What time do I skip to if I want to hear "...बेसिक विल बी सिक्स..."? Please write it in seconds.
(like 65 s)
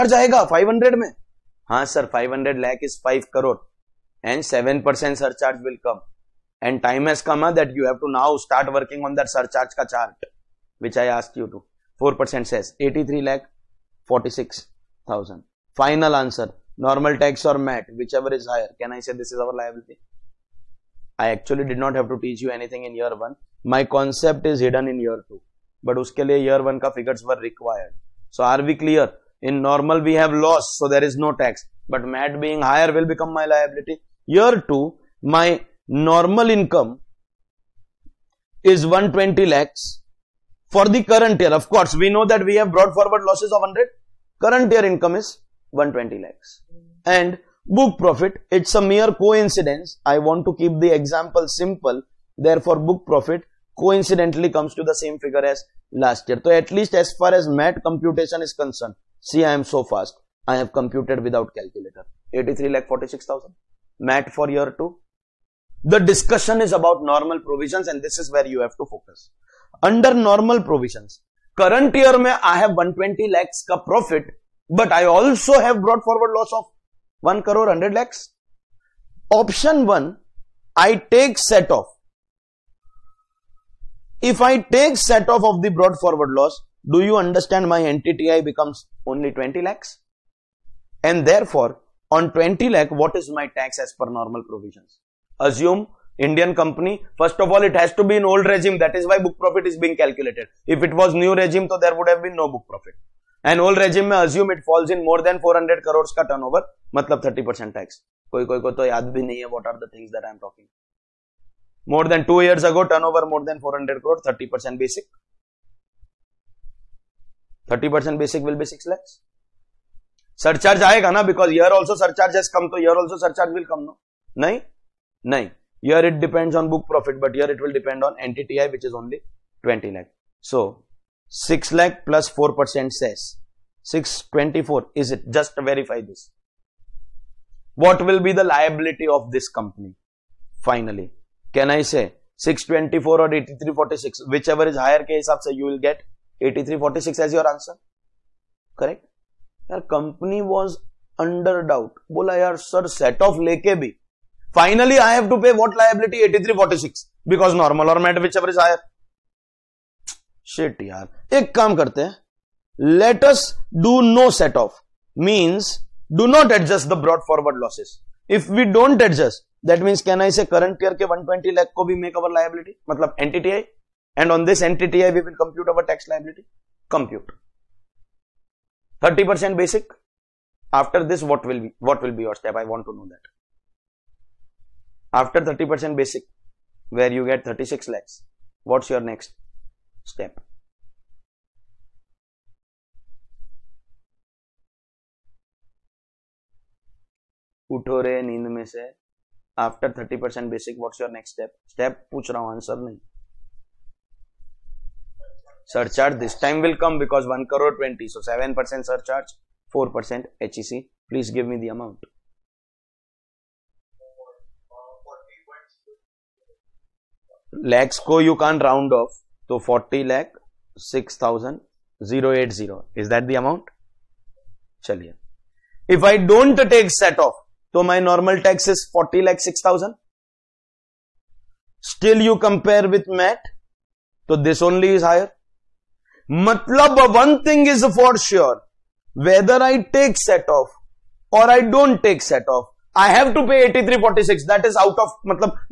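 118 s.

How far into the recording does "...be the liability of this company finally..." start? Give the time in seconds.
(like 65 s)
138 s.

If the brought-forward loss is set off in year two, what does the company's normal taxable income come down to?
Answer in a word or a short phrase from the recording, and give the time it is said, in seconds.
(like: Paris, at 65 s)
20 lakhs, at 89 s.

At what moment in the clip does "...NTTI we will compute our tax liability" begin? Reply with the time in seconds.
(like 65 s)
174 s.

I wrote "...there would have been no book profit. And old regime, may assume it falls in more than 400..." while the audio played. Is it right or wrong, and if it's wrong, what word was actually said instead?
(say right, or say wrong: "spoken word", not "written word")
right.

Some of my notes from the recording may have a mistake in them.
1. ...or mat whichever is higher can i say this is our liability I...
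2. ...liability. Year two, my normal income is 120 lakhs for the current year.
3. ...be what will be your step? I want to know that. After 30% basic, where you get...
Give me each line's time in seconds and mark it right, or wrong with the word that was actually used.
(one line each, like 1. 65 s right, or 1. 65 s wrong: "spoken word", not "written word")
1. 17 s right
2. 33 s right
3. 181 s right.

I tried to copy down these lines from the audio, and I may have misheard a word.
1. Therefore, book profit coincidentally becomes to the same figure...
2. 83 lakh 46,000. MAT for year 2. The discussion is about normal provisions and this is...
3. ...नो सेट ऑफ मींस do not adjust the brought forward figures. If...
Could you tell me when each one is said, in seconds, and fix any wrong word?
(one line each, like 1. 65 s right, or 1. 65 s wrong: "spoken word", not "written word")
1. 52 s wrong: "comes", not "becomes"
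2. 62 s right
3. 164 s wrong: "losses", not "figures".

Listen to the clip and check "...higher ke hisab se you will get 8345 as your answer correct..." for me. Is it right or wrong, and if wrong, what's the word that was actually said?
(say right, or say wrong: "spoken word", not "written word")
wrong: "8346", not "8345".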